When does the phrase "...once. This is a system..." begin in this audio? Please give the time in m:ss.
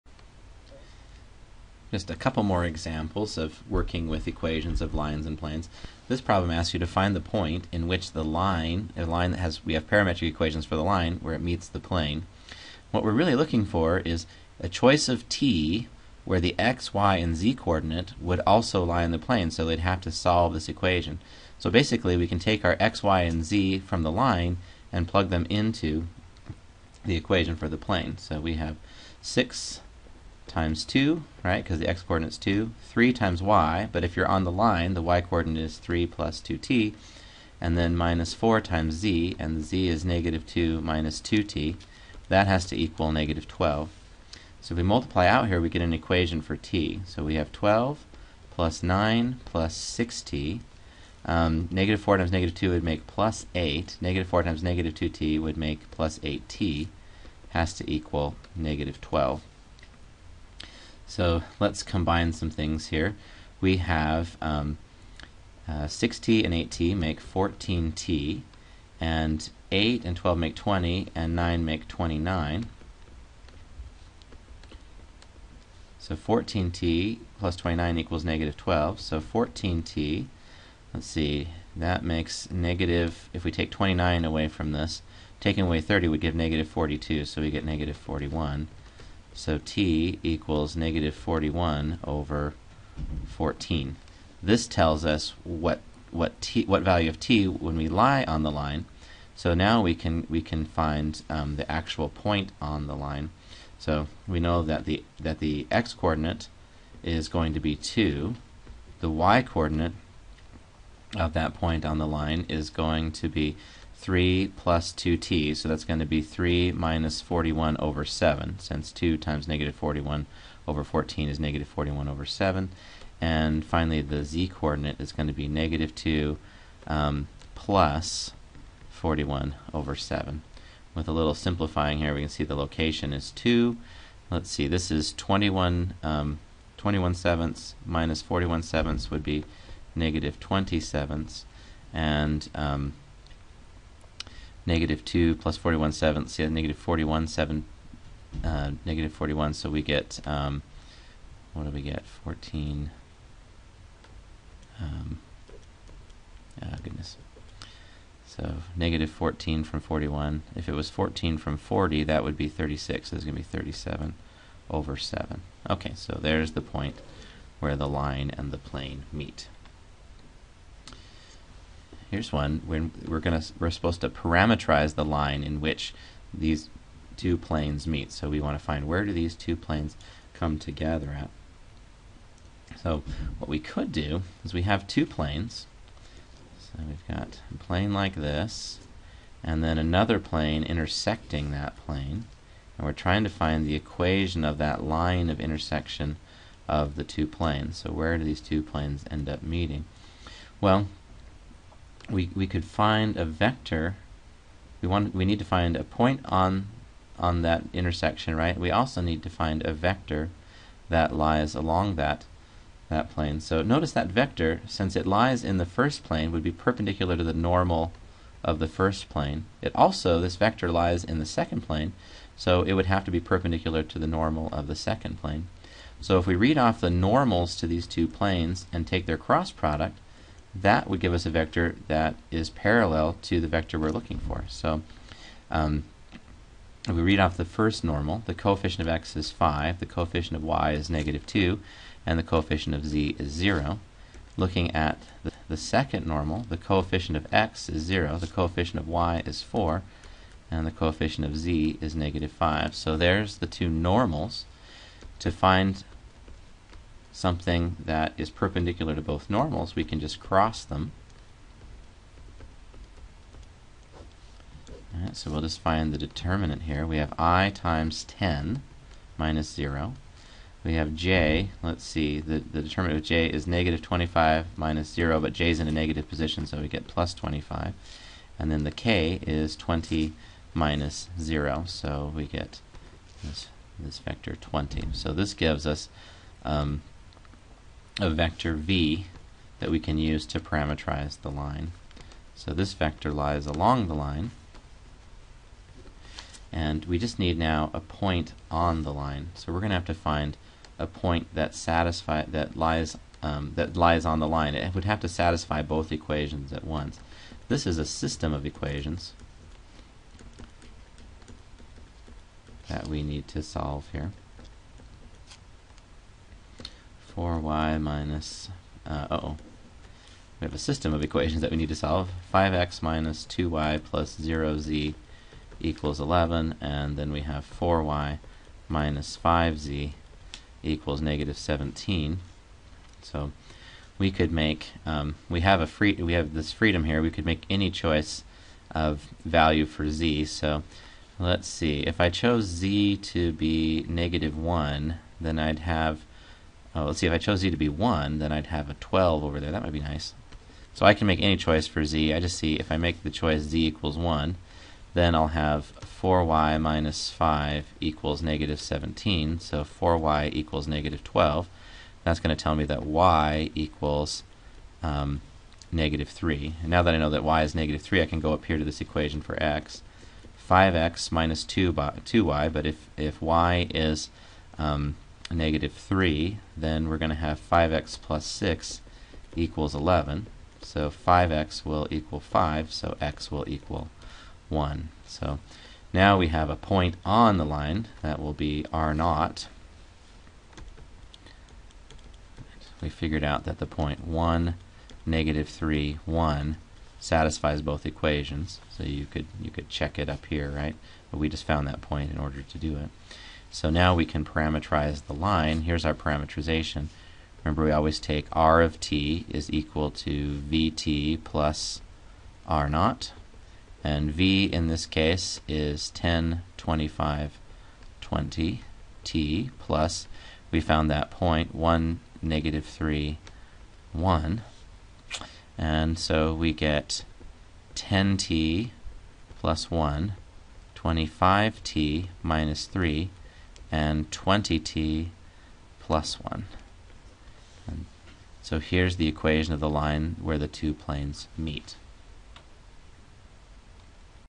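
5:06.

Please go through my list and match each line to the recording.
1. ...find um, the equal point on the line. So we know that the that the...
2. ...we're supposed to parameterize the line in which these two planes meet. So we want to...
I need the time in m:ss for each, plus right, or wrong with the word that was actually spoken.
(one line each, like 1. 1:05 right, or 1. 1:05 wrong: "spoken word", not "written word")
1. 1:40 wrong: "actual", not "equal"
2. 2:53 right.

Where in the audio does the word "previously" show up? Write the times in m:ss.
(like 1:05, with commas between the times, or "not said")
not said.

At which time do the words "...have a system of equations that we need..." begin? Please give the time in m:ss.
5:20.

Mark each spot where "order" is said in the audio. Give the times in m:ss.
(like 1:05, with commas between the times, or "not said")
6:42.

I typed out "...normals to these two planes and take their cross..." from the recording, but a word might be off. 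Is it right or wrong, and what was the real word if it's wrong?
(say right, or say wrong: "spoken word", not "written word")
right.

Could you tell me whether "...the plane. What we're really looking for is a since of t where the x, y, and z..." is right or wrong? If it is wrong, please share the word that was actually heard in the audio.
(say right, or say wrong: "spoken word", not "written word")
wrong: "choice", not "since".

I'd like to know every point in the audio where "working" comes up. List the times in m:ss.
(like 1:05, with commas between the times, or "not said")
0:03.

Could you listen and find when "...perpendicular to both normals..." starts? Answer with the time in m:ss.
4:18.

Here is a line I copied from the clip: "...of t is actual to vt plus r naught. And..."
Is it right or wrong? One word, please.
wrong.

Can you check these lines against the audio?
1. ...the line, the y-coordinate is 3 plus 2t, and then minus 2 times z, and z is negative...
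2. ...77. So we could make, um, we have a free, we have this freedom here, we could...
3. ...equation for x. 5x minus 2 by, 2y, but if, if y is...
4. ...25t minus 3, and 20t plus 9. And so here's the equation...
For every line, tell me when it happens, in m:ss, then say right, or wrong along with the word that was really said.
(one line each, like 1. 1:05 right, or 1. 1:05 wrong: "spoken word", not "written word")
1. 0:34 wrong: "4", not "2"
2. 5:31 wrong: "17", not "77"
3. 6:08 right
4. 7:10 wrong: "1", not "9".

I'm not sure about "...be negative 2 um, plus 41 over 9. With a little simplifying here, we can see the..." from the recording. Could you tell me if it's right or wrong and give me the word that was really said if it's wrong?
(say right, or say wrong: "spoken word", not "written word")
wrong: "7", not "9".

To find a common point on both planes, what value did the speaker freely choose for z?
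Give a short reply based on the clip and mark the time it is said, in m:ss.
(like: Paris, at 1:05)
1, at 5:53.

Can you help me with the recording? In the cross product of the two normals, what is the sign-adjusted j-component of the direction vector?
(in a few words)
25.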